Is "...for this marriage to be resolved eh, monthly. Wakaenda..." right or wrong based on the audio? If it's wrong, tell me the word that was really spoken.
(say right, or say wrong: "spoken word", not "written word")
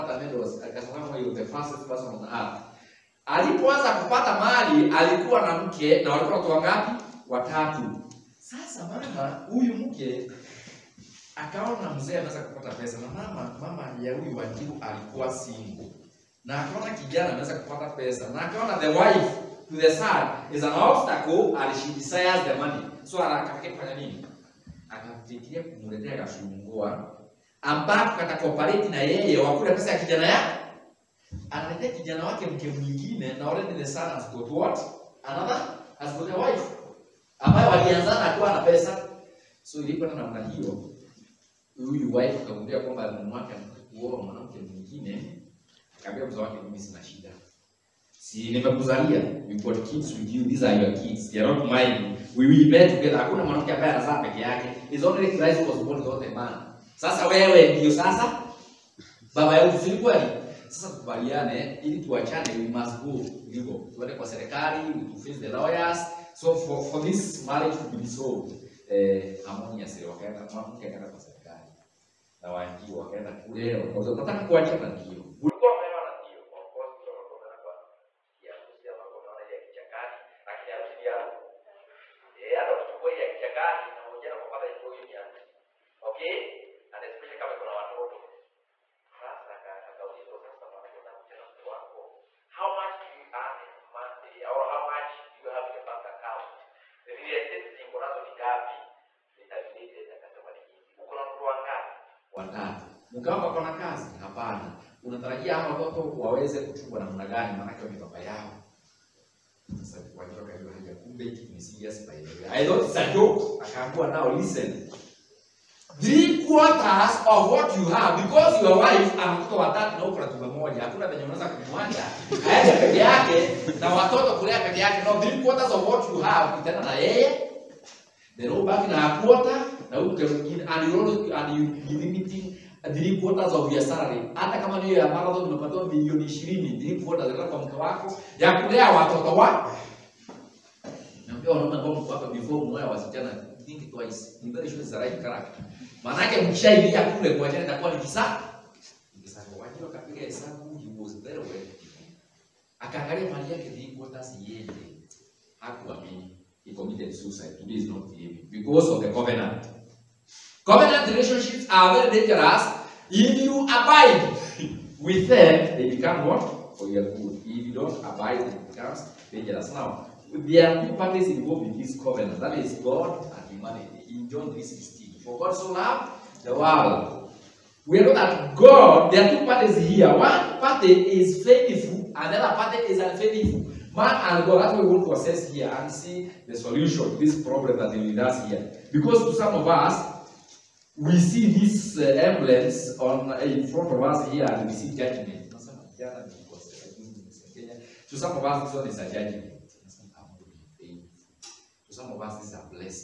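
wrong: "harmoniously", not "monthly".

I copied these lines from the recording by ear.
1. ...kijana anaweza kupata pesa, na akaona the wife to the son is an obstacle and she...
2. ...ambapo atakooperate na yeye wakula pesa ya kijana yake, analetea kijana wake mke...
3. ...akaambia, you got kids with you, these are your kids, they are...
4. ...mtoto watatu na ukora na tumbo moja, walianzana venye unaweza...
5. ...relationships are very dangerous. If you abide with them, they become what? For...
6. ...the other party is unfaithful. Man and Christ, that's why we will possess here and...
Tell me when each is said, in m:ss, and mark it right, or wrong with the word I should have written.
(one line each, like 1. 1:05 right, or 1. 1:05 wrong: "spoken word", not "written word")
1. 0:16 right
2. 0:27 right
3. 0:48 wrong: "nimekuzalia", not "akaambia"
4. 1:59 wrong: "hakuna", not "walianzana"
5. 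2:41 right
6. 3:02 wrong: "God", not "Christ".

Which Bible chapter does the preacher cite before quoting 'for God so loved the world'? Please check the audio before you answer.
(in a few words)
John 16.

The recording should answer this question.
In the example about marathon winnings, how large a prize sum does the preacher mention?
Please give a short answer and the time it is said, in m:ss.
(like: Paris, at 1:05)
20 million, at 2:15.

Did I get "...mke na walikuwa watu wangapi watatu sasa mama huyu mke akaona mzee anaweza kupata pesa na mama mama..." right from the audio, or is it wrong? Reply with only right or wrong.
right.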